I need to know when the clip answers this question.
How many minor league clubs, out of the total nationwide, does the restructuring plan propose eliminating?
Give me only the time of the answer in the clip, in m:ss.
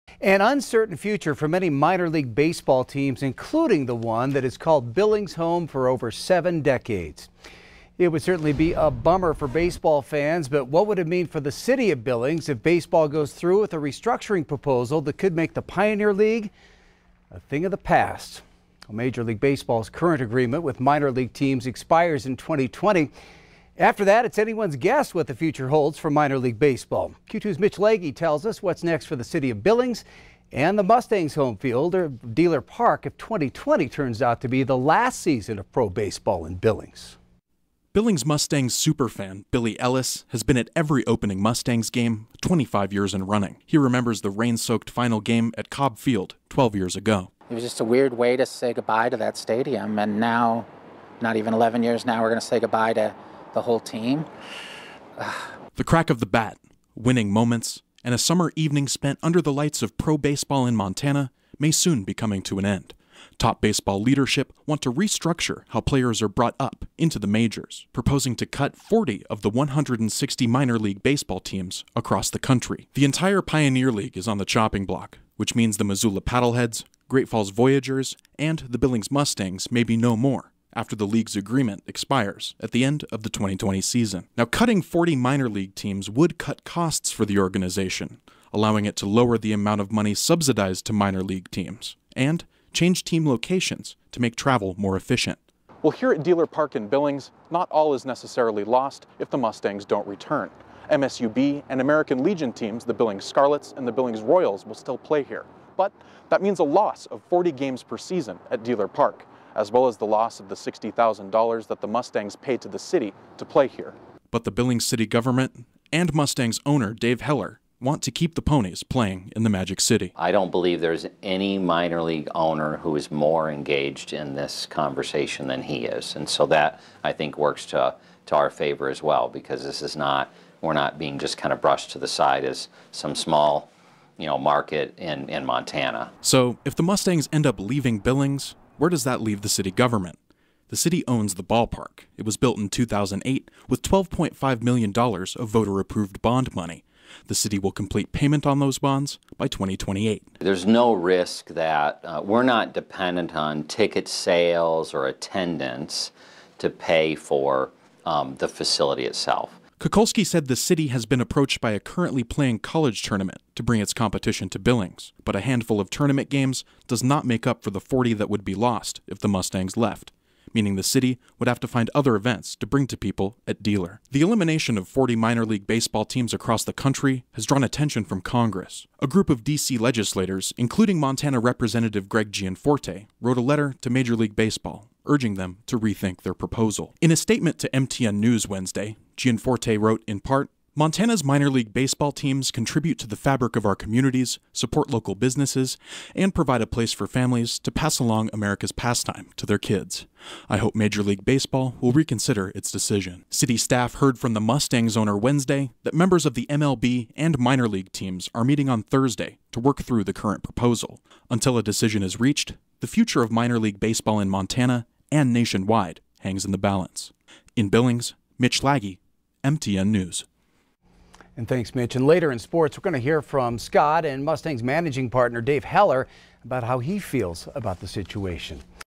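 1:08.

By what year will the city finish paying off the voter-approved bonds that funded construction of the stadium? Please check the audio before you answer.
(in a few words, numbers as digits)
2028.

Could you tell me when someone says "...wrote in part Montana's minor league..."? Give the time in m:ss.
3:09.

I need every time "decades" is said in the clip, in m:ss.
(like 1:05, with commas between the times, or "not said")
0:06.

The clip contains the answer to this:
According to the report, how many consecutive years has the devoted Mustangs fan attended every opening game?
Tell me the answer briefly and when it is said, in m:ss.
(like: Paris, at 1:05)
25, at 0:42.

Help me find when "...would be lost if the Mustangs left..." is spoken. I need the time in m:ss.
2:48.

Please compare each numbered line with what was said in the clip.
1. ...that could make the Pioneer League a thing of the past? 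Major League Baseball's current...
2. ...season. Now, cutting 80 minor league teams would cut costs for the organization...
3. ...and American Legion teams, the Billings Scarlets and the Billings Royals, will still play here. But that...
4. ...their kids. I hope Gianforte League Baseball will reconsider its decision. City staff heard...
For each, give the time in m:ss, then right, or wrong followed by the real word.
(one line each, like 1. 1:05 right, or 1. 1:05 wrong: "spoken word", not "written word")
1. 0:15 right
2. 1:23 wrong: "40", not "80"
3. 1:41 right
4. 3:19 wrong: "Major", not "Gianforte".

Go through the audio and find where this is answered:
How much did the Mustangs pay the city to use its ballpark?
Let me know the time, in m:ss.
1:50.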